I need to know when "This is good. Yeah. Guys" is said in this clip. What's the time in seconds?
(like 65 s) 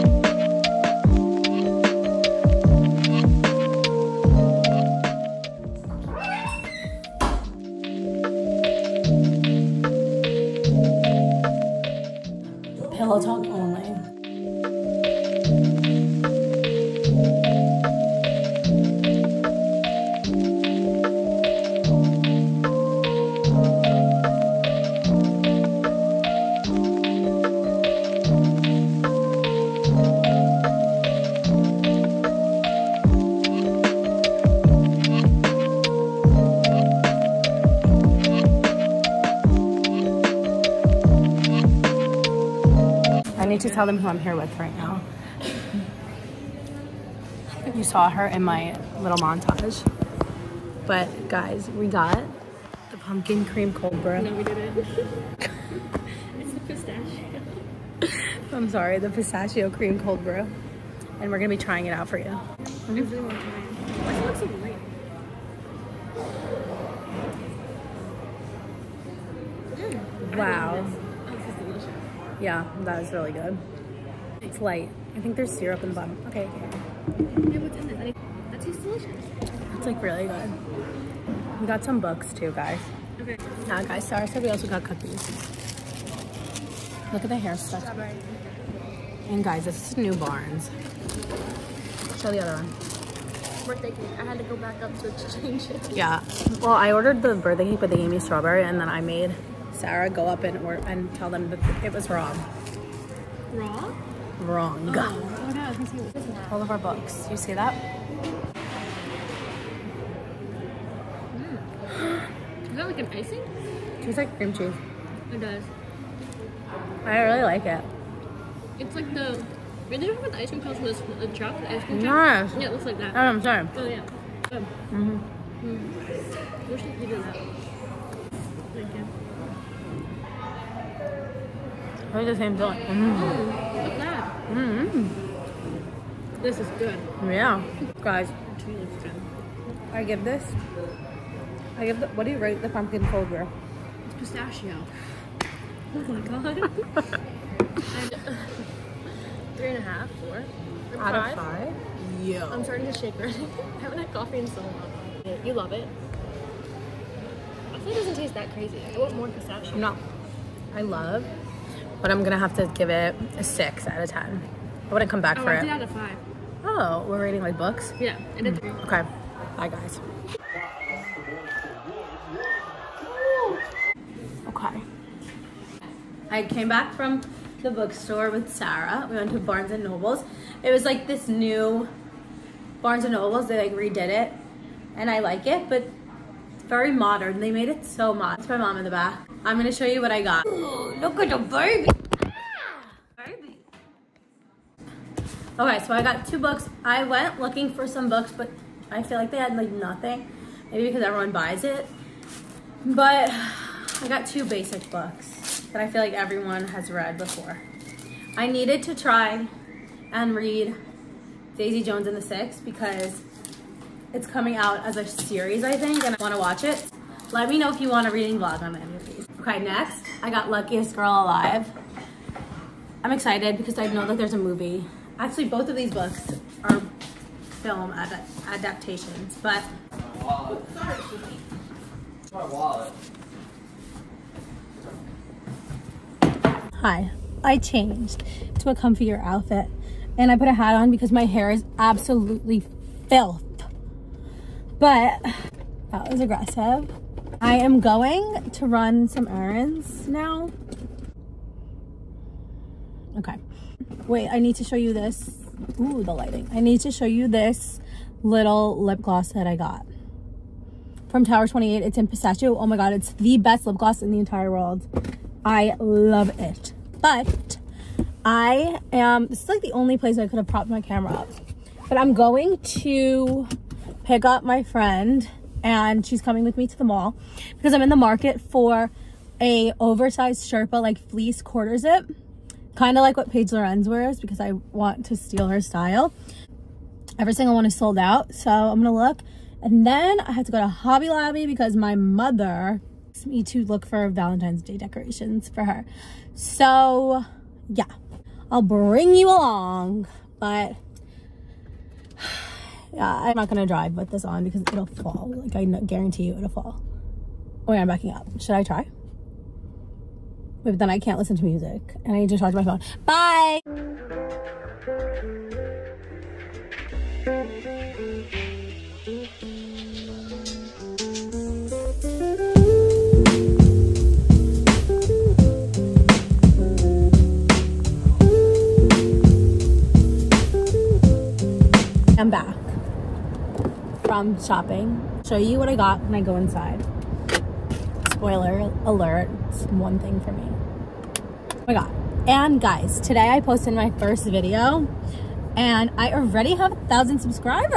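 136 s.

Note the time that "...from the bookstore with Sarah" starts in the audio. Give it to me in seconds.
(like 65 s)
176 s.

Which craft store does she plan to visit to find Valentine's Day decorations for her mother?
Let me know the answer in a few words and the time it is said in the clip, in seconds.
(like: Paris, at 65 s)
Hobby Lobby, at 290 s.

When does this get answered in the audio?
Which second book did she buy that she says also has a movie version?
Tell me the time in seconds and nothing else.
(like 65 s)
220 s.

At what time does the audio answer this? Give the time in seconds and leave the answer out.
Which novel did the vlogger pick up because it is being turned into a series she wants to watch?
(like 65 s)
211 s.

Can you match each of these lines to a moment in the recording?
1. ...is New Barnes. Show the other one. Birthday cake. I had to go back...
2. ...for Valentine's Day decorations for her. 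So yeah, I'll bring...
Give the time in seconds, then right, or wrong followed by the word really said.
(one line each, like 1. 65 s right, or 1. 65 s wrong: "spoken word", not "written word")
1. 89 s right
2. 293 s right.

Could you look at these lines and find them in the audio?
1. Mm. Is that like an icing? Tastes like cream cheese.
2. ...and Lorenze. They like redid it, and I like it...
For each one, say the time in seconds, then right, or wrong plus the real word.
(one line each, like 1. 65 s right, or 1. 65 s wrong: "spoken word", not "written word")
1. 111 s right
2. 183 s wrong: "Nobles", not "Lorenze".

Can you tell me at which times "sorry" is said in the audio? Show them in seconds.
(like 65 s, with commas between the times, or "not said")
58 s, 84 s, 123 s, 230 s.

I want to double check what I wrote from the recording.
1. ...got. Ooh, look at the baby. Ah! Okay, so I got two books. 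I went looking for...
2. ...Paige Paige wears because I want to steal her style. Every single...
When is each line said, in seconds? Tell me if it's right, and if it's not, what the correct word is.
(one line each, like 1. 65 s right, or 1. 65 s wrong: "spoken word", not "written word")
1. 190 s right
2. 283 s wrong: "Lorenze", not "Paige".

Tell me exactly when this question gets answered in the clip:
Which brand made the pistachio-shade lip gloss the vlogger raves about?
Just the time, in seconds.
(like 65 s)
261 s.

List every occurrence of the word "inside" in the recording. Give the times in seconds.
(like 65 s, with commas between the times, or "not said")
336 s.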